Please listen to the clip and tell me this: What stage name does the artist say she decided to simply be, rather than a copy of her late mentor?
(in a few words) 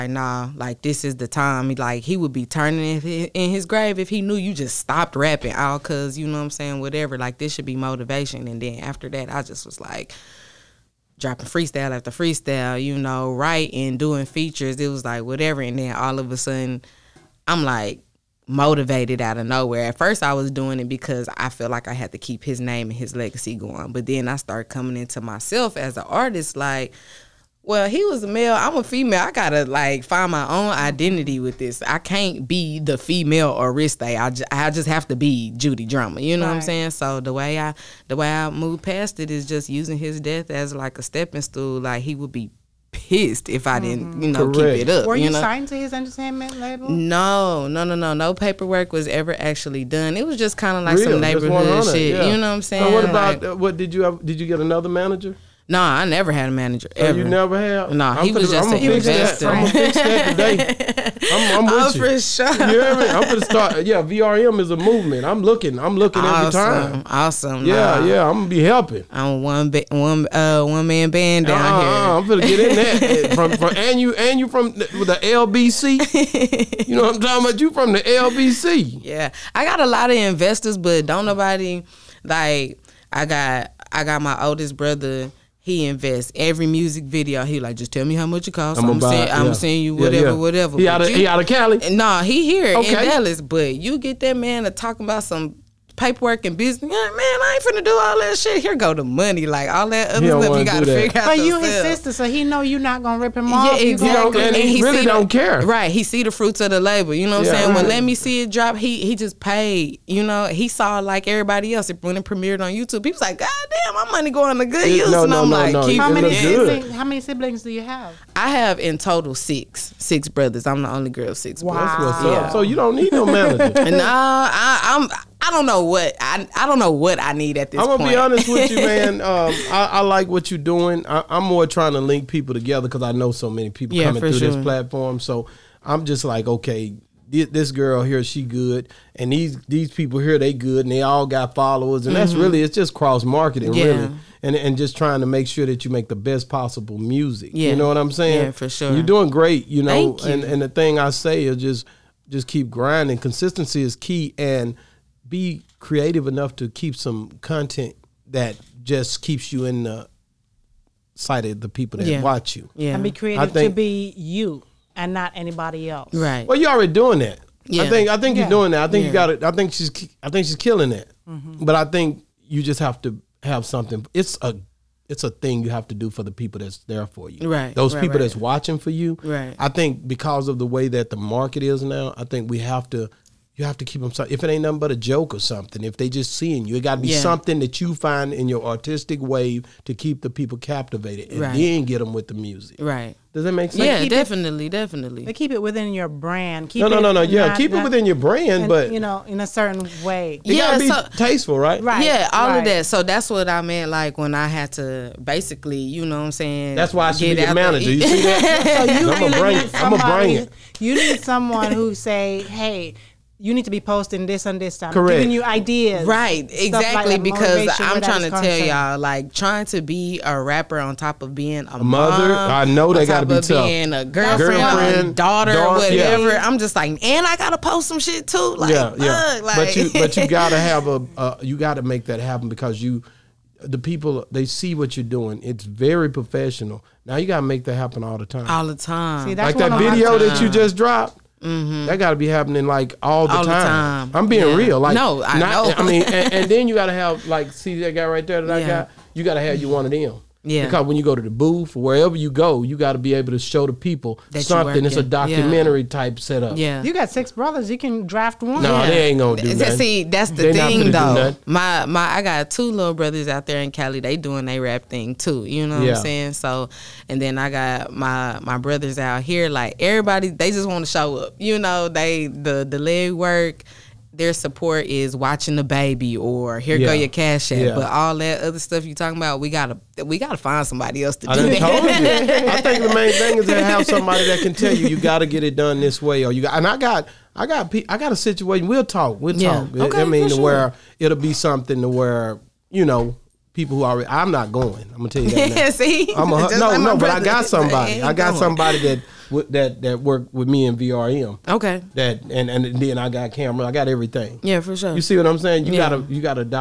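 Judy Drama.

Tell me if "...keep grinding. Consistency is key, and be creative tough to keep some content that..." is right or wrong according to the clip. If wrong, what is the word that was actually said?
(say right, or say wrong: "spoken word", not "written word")
wrong: "enough", not "tough".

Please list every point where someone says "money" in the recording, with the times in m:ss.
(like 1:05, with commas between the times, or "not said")
1:39, 1:54.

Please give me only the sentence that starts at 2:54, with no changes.
It's a it's a thing you have to do for the people that's there for you.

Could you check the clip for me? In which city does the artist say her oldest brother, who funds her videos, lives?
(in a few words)
Dallas.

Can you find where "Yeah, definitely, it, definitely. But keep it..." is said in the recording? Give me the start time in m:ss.
3:13.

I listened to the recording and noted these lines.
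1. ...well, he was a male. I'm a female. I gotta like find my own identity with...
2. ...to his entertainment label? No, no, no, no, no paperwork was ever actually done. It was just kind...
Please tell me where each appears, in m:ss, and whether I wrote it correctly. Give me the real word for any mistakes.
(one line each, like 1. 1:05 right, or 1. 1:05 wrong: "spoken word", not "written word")
1. 0:27 right
2. 0:45 right.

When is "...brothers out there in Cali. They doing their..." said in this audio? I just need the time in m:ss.
4:22.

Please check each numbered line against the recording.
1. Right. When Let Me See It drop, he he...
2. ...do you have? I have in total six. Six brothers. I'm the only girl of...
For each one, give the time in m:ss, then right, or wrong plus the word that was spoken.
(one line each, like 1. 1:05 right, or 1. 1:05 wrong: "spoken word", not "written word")
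1. 1:47 right
2. 1:57 right.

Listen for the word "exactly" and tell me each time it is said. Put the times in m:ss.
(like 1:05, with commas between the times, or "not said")
1:43, 3:36.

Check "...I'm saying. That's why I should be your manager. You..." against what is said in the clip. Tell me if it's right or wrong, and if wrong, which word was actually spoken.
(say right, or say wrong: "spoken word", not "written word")
right.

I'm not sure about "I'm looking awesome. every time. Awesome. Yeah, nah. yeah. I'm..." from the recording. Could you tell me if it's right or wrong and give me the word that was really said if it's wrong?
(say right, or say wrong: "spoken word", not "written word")
right.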